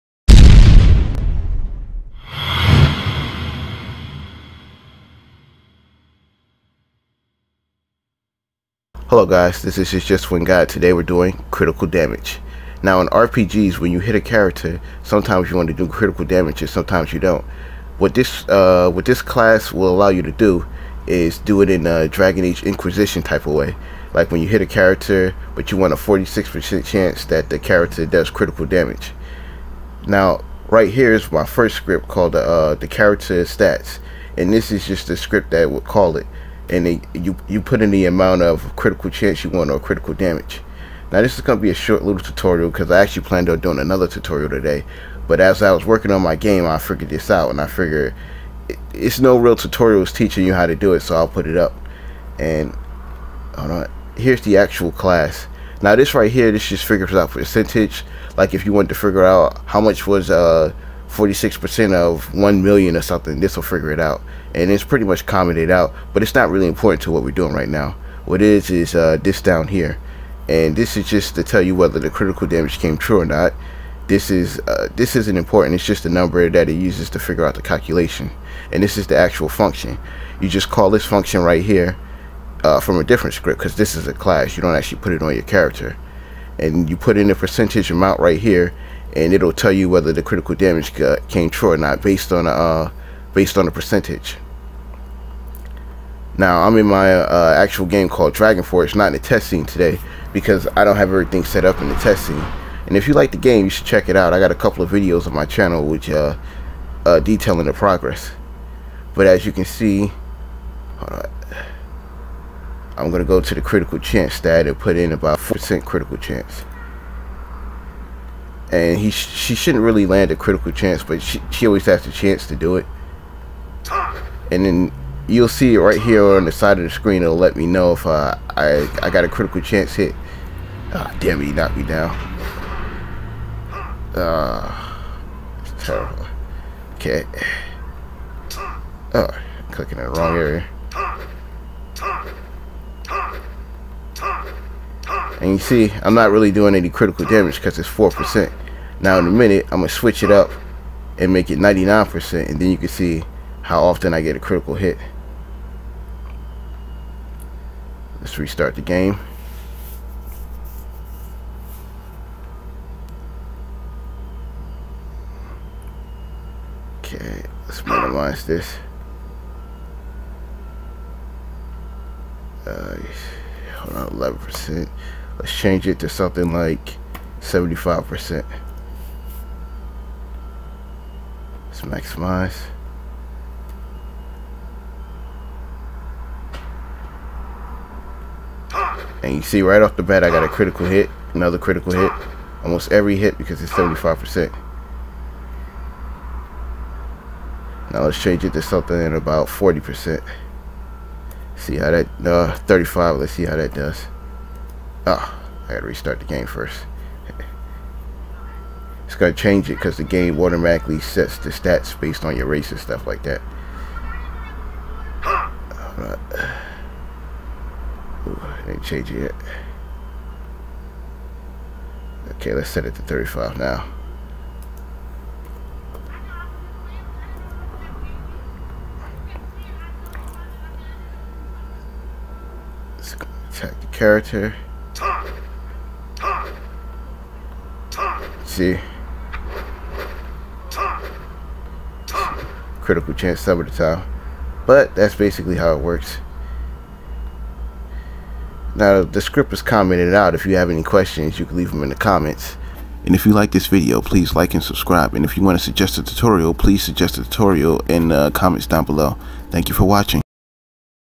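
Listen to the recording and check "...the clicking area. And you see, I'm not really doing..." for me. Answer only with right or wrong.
wrong.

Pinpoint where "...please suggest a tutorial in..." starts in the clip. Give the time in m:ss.
4:16.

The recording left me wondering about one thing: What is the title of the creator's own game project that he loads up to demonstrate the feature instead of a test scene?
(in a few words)
Dragon Forge.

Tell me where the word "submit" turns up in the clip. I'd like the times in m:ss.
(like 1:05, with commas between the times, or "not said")
not said.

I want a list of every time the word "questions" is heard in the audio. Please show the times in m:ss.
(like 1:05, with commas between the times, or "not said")
4:10.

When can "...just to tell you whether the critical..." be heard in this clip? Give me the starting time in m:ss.
1:11.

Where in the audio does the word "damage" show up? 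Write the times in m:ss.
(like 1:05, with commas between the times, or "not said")
0:11, 0:16, 0:28, 0:40, 1:12, 1:30, 2:27.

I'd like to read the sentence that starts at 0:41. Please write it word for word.
Now this is going to be a short little tutorial because I actually planned on doing another tutorial today.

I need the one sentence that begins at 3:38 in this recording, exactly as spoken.
Ooh, it Okay, let's set it to 35 now.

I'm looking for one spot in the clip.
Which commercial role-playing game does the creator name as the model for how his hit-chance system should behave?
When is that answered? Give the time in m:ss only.
0:22.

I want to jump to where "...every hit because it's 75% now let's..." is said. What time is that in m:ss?
3:12.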